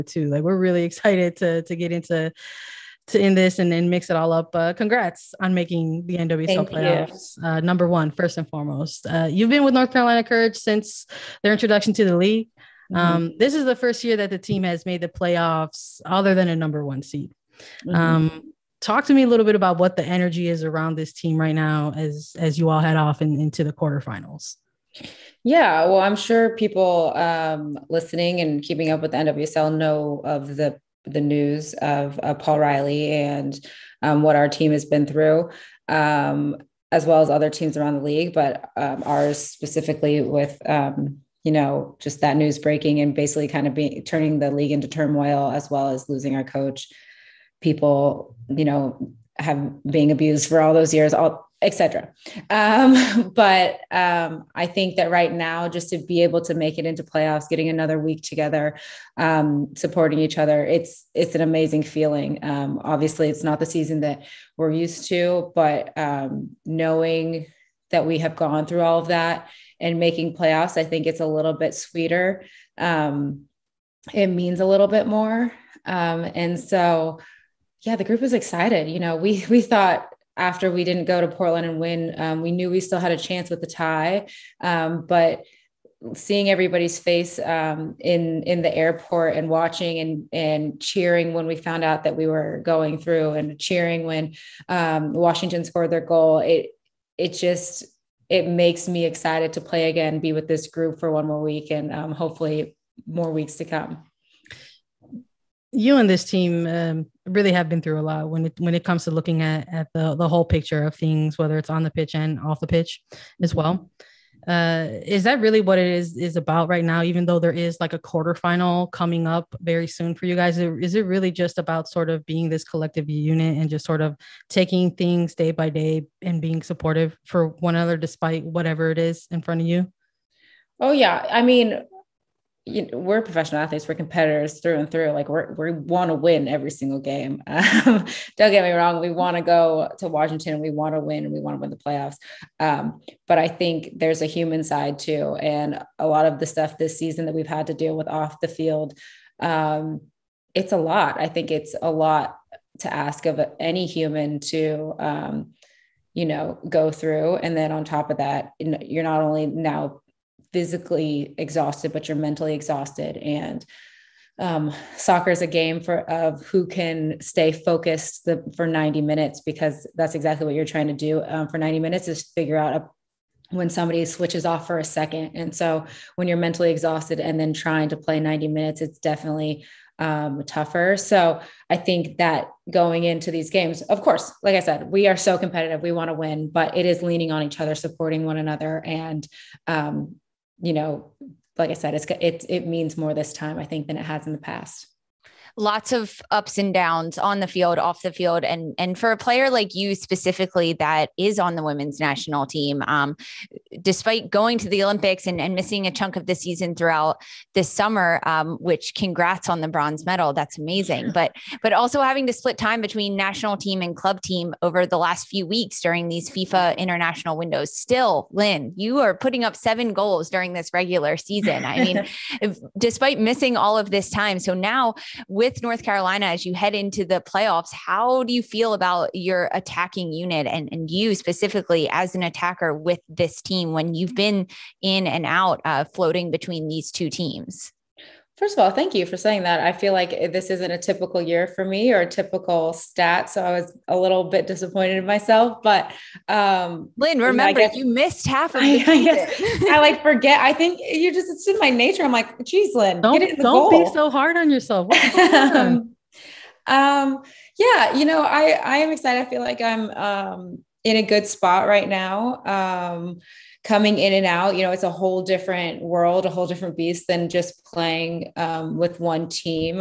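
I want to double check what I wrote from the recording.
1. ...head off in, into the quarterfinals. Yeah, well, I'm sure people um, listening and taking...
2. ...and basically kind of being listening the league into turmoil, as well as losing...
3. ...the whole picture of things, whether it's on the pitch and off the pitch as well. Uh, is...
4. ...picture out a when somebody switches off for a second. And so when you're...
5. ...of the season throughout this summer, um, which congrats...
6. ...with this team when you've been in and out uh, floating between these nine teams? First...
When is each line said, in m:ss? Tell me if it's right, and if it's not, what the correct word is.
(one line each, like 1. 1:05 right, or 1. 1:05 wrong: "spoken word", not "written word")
1. 0:22 wrong: "keeping", not "taking"
2. 0:42 wrong: "turning", not "listening"
3. 1:50 right
4. 2:52 wrong: "figure", not "picture"
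5. 3:26 right
6. 3:52 wrong: "two", not "nine".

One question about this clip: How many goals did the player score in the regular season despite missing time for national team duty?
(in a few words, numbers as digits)
7.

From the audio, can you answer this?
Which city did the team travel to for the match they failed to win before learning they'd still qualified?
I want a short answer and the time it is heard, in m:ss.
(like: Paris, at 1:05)
Portland, at 1:21.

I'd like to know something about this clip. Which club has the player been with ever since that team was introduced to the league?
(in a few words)
North Carolina Courage.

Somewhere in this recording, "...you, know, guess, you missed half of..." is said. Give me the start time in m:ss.
4:07.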